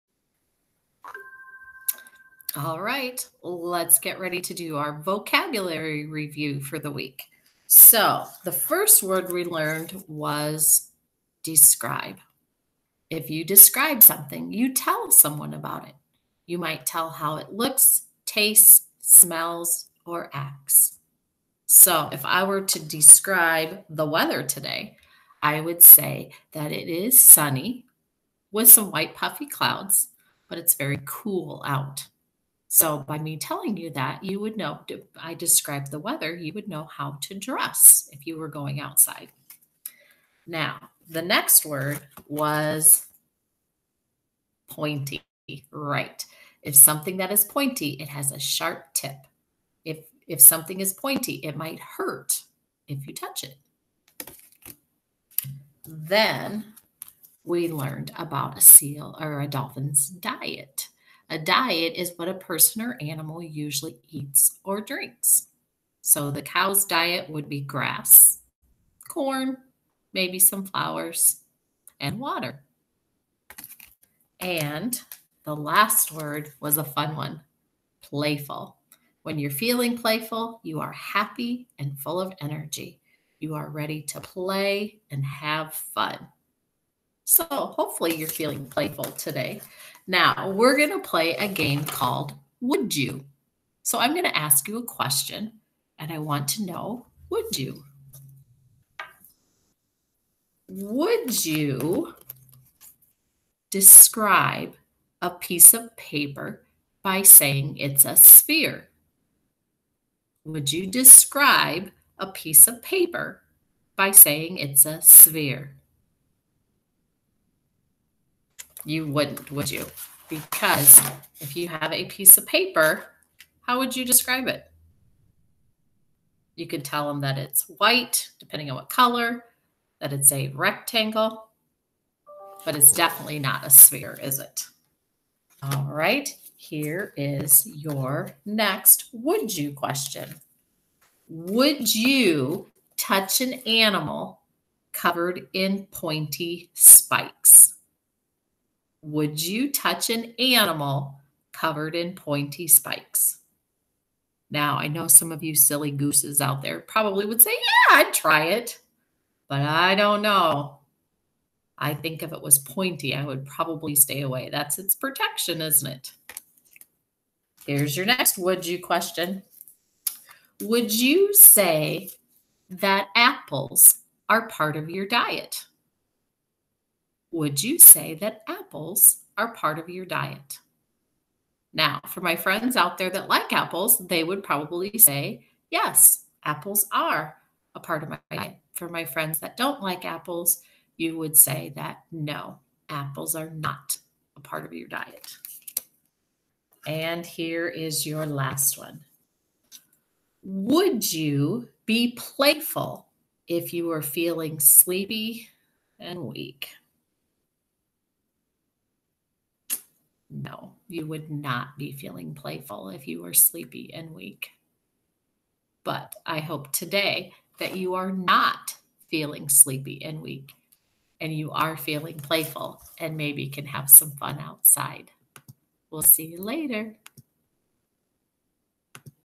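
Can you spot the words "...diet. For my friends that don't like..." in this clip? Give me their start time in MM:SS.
03:08.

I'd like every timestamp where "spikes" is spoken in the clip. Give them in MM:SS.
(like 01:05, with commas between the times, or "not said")
02:26, 02:32.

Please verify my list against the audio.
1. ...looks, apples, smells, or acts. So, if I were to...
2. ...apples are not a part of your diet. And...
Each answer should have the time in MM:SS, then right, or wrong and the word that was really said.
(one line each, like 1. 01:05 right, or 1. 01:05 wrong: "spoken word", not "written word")
1. 00:17 wrong: "tastes", not "apples"
2. 03:12 right.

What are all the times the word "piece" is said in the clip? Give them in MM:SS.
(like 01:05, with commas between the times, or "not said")
01:45, 01:52, 02:02.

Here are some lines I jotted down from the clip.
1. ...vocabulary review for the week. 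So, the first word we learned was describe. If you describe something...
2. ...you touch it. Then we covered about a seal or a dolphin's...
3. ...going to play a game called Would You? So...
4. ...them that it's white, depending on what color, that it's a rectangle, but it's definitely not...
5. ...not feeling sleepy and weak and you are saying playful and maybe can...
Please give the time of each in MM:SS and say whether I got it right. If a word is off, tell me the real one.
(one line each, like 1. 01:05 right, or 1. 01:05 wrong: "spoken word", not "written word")
1. 00:05 right
2. 00:53 wrong: "learned", not "covered"
3. 01:30 right
4. 02:07 right
5. 03:38 wrong: "feeling", not "saying".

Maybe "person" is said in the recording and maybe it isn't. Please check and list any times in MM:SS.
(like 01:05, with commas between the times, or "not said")
01:02.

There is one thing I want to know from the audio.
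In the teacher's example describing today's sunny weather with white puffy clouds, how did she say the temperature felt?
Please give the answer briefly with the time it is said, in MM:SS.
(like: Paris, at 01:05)
very cool, at 00:30.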